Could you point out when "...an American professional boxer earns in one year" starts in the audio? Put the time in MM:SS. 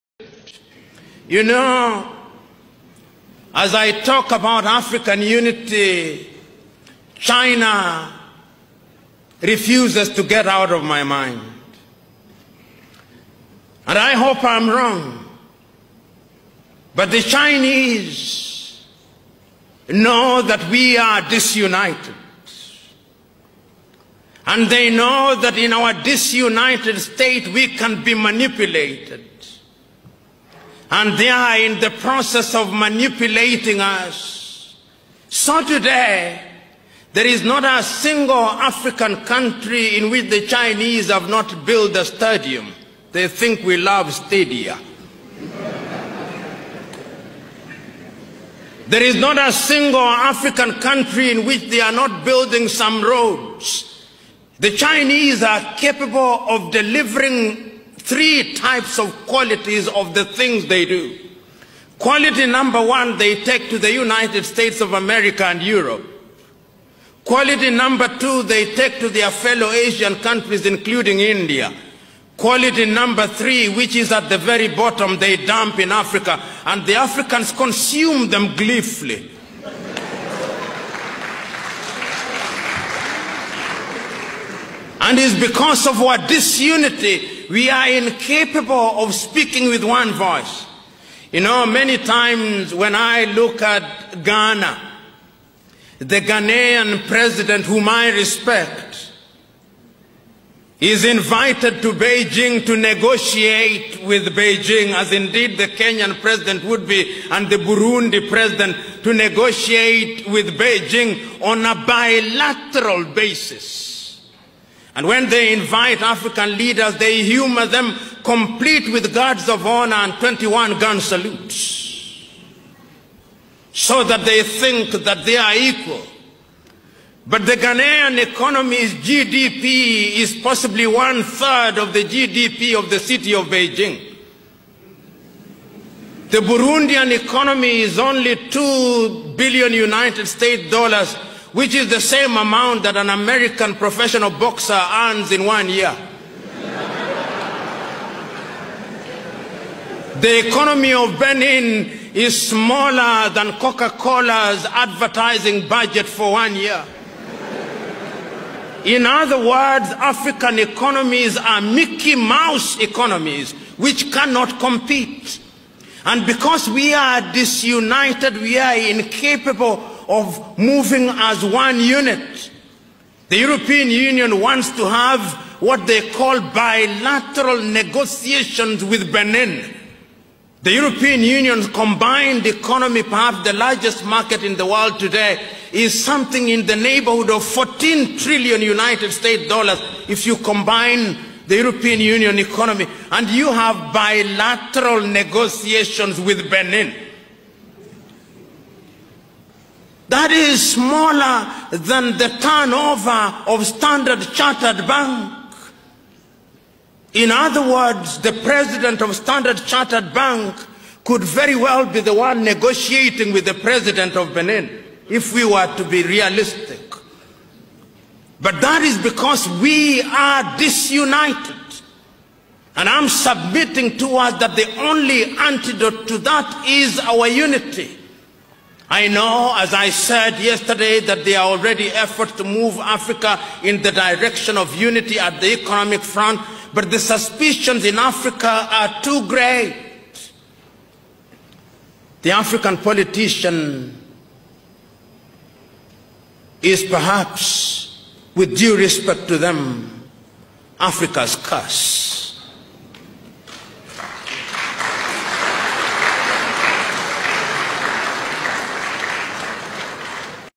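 02:22.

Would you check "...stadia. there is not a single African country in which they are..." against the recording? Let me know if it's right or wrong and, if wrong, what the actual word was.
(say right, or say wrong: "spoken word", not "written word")
right.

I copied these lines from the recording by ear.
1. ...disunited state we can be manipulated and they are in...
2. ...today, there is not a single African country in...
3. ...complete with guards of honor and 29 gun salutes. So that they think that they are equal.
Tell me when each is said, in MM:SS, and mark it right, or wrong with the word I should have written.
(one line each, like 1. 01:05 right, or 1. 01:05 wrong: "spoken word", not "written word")
1. 00:25 right
2. 00:35 right
3. 01:58 wrong: "21", not "29".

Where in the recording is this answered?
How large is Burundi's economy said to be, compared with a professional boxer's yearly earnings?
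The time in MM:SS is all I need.
02:18.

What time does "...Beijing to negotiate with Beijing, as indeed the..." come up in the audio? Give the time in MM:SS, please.
01:41.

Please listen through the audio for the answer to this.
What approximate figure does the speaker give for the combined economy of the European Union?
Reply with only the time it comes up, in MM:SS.
03:07.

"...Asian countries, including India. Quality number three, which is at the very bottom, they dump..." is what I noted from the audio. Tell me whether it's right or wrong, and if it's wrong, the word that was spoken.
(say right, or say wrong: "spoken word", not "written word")
right.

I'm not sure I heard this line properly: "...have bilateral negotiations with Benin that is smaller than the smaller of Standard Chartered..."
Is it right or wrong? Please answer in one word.
wrong.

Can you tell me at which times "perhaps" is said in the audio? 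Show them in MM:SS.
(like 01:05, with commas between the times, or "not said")
03:03, 04:06.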